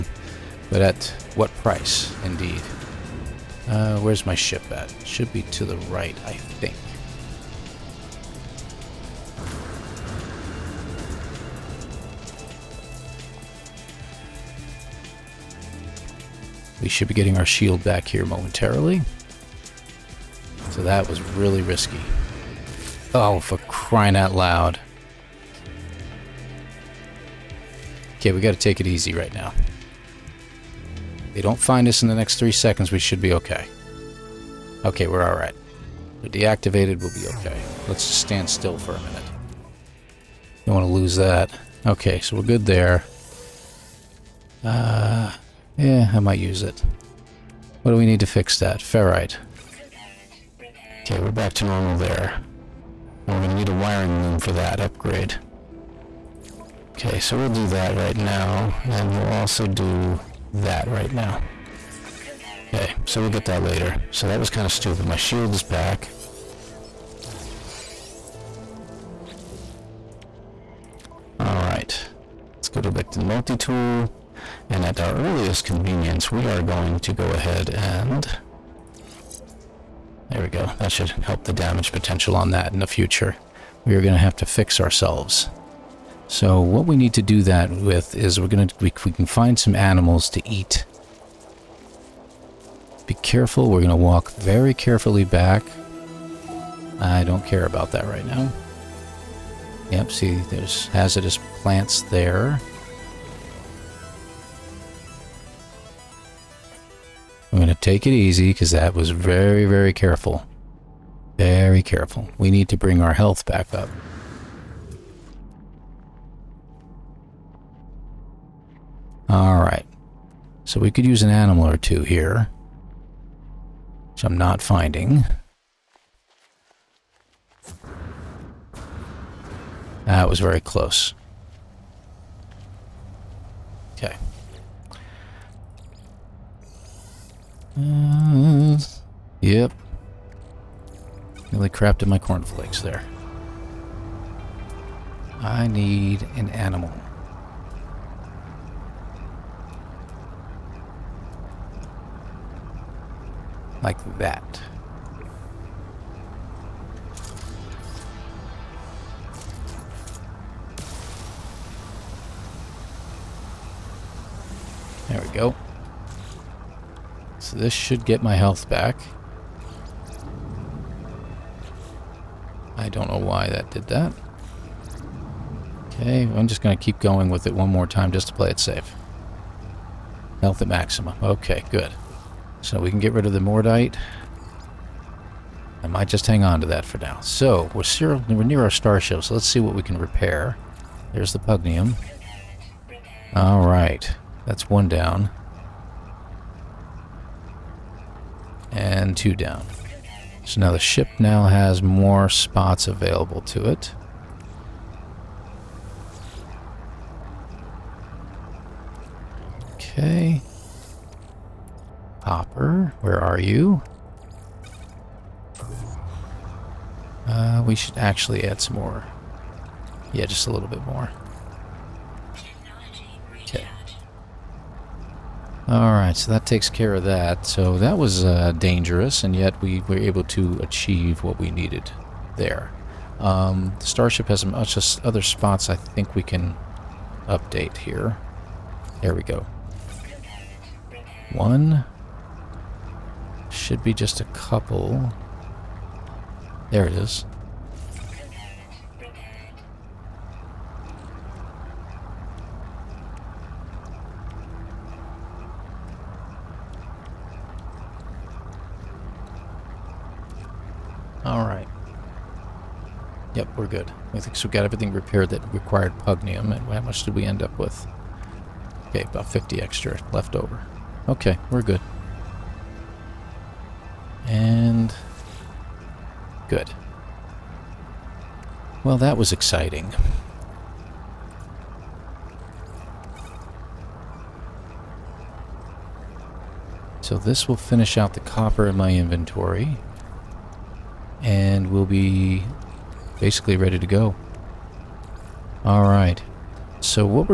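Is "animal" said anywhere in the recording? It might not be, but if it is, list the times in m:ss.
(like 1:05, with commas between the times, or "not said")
1:29, 2:01, 2:26.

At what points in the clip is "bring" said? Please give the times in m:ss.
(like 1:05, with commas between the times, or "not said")
1:52.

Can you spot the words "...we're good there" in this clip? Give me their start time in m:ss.
0:42.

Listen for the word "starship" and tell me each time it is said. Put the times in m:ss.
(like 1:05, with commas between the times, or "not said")
3:08, 3:53.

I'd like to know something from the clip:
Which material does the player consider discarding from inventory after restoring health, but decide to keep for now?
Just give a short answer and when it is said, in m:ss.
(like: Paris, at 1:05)
Mordite, at 3:03.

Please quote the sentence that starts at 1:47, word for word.
I'm going to take it easy because that was very, very careful.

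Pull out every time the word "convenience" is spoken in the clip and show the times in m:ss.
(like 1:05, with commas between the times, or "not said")
1:15.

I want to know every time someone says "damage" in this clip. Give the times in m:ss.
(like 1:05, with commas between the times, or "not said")
1:21.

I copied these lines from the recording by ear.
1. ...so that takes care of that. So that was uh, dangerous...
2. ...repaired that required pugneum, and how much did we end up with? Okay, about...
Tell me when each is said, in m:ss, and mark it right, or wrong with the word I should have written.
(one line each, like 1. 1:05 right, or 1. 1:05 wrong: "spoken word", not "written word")
1. 3:46 right
2. 4:24 right.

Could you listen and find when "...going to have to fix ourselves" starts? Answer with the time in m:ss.
1:24.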